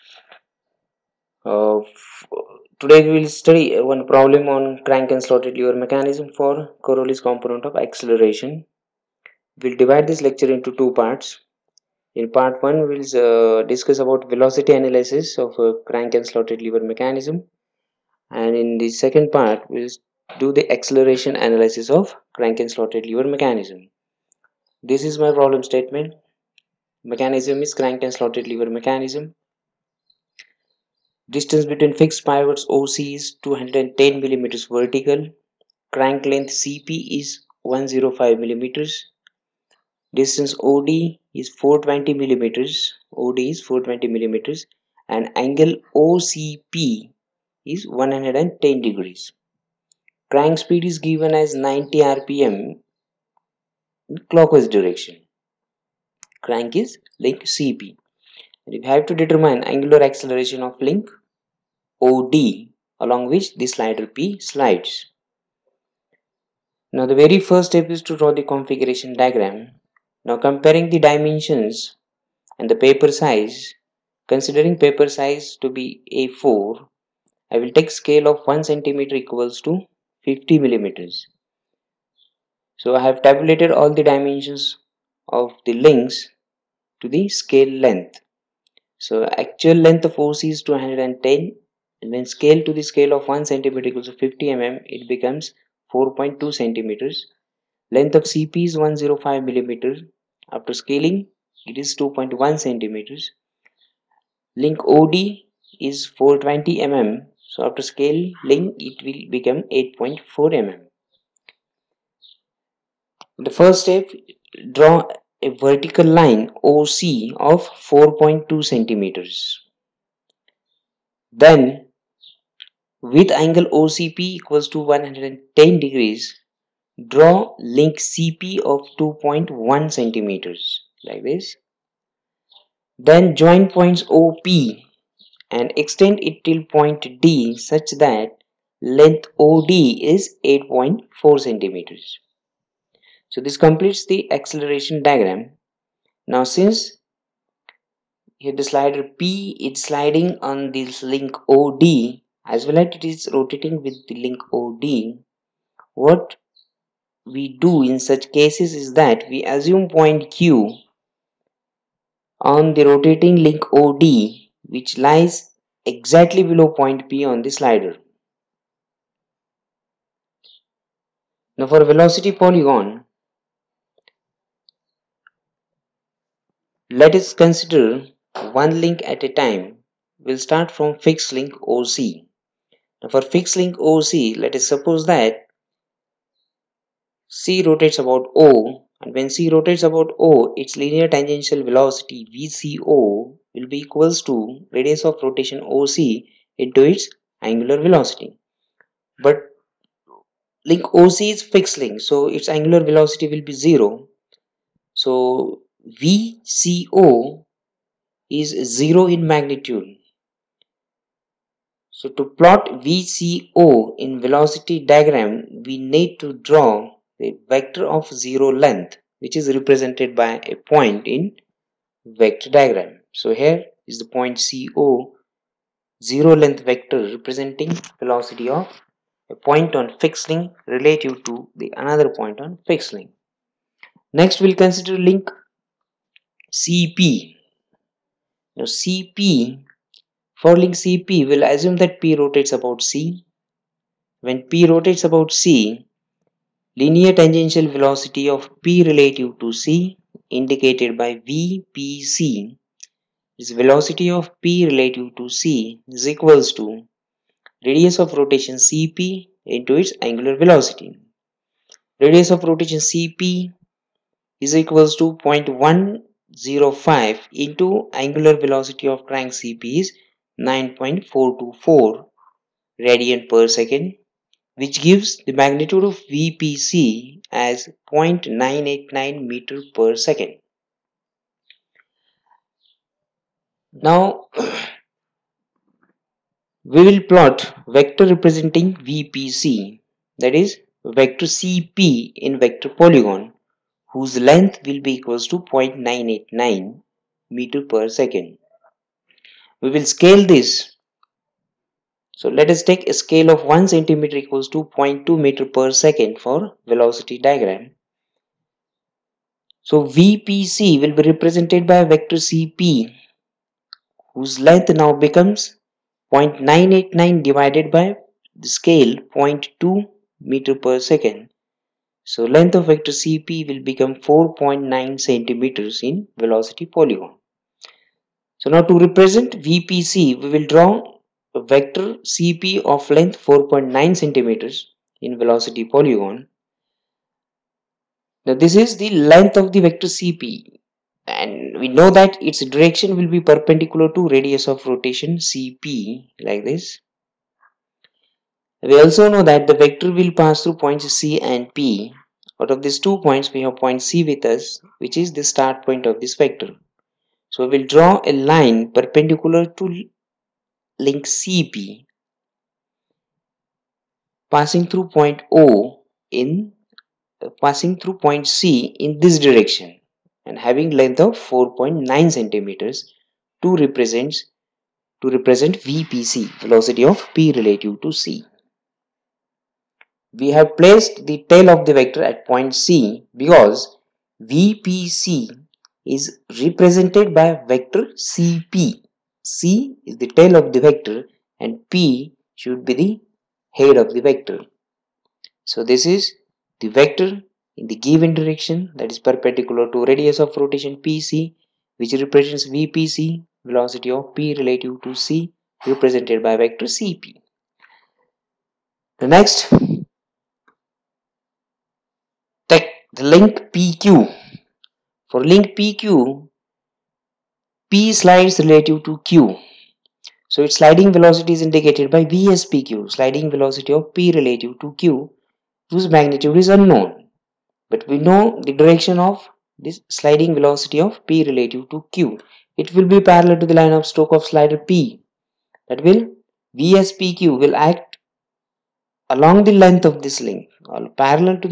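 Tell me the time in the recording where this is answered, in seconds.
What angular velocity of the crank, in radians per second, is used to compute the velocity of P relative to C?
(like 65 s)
270 s.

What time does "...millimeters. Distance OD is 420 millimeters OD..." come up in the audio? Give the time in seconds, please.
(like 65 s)
38 s.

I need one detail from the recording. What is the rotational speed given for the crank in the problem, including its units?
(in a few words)
90 rpm.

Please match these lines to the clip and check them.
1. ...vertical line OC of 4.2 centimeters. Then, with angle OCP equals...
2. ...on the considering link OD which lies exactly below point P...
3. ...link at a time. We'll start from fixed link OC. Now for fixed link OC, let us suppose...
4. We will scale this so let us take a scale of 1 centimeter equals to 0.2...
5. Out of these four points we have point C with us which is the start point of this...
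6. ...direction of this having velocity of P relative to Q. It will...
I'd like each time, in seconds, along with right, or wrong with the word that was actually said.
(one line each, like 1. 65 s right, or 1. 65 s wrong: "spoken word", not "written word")
1. 115 s right
2. 162 s wrong: "rotating", not "considering"
3. 178 s right
4. 299 s right
5. 352 s wrong: "two", not "four"
6. 428 s wrong: "sliding", not "having".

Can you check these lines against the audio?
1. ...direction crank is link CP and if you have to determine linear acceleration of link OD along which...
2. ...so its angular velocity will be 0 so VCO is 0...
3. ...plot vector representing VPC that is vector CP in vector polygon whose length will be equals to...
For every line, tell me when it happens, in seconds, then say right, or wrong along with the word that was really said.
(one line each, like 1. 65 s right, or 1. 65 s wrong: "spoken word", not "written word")
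1. 54 s wrong: "angular", not "linear"
2. 202 s right
3. 287 s right.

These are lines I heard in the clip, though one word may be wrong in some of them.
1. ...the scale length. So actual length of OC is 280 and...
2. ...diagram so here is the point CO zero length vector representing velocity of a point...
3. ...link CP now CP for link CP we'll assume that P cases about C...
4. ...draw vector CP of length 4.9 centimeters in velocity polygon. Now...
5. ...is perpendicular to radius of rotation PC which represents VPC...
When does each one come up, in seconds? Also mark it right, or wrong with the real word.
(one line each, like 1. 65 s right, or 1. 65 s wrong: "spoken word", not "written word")
1. 87 s wrong: "210", not "280"
2. 222 s right
3. 235 s wrong: "rotates", not "cases"
4. 330 s right
5. 398 s right.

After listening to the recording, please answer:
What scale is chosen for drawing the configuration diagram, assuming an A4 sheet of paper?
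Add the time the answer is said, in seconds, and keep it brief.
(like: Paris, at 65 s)
1 centimeter equals 50 millimeters, at 78 s.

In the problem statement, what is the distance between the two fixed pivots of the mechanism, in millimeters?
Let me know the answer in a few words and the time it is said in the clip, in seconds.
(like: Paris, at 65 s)
210 millimeters, at 33 s.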